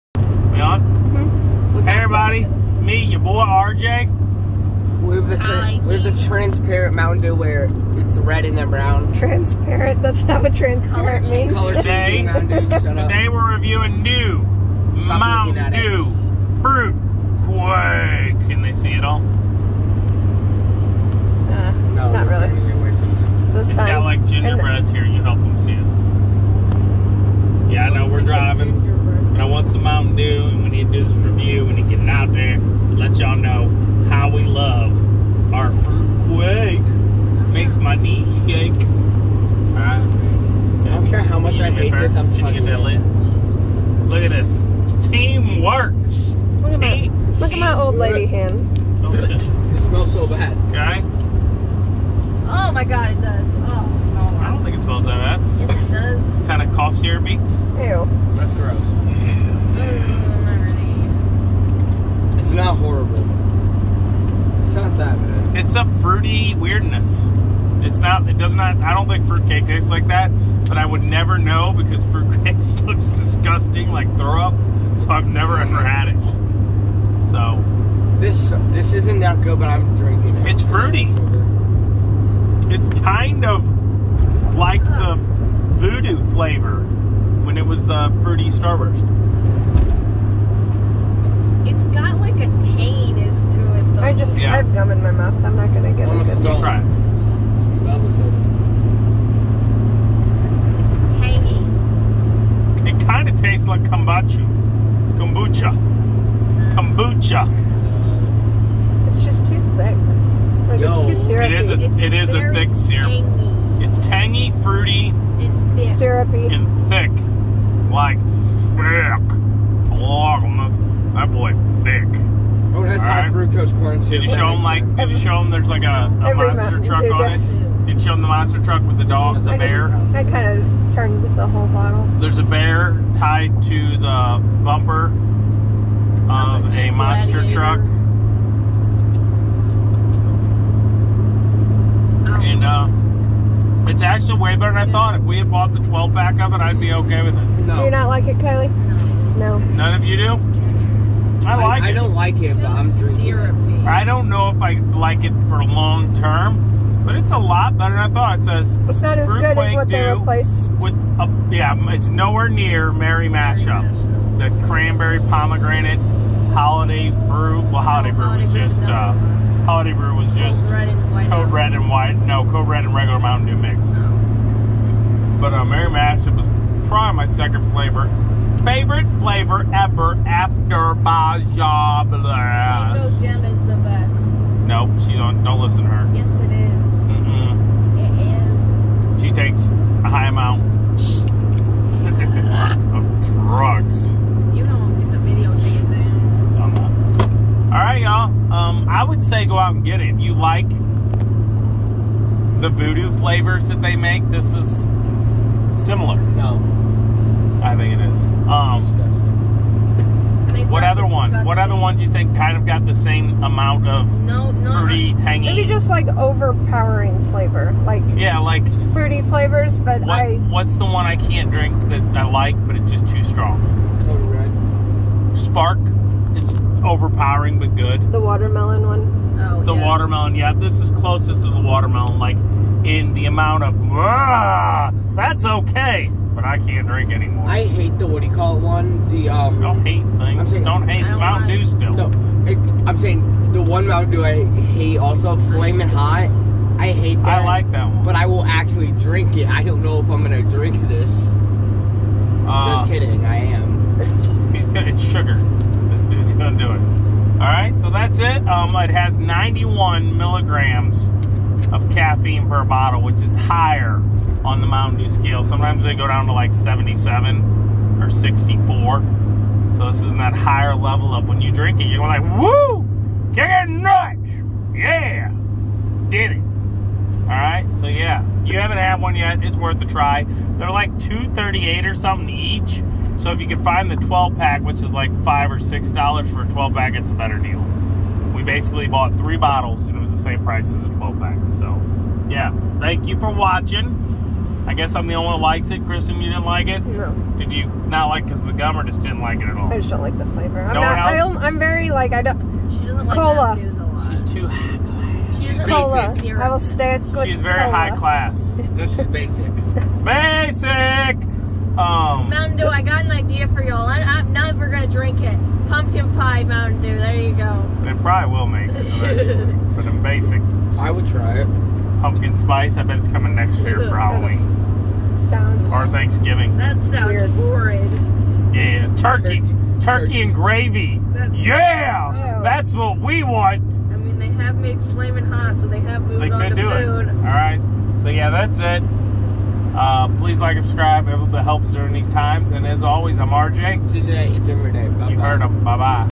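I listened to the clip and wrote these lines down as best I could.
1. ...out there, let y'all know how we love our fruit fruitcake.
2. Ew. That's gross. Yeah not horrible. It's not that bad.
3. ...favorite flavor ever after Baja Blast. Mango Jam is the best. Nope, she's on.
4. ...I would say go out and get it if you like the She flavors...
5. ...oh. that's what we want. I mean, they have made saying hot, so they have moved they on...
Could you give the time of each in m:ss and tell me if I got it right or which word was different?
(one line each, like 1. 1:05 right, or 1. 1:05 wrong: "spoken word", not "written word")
1. 0:32 wrong: "quake", not "fruitcake"
2. 0:57 right
3. 2:58 right
4. 3:18 wrong: "VooDew", not "She"
5. 5:32 wrong: "flaming", not "saying".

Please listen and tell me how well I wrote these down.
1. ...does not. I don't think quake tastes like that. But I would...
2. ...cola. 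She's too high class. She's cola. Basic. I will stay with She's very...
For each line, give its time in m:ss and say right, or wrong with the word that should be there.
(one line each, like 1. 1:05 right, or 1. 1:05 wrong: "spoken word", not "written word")
1. 1:08 wrong: "fruitcake", not "quake"
2. 5:03 right.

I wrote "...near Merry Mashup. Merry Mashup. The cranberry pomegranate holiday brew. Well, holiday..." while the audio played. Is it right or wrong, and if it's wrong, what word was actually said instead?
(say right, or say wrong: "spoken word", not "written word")
right.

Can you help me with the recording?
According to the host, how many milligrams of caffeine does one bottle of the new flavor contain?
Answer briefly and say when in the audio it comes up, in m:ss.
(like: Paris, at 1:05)
91, at 4:19.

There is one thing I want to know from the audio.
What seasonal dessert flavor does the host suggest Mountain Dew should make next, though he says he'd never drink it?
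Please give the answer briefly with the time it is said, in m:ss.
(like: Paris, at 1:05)
Pumpkin pie, at 5:15.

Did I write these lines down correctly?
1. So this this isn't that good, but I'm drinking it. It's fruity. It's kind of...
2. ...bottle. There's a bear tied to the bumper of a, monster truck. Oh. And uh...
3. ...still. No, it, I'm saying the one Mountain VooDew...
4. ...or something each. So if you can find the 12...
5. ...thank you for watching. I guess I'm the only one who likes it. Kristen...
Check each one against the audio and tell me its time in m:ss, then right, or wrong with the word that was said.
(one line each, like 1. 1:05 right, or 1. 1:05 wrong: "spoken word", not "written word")
1. 1:17 right
2. 2:11 right
3. 4:01 wrong: "Dew", not "VooDew"
4. 4:41 right
5. 4:52 right.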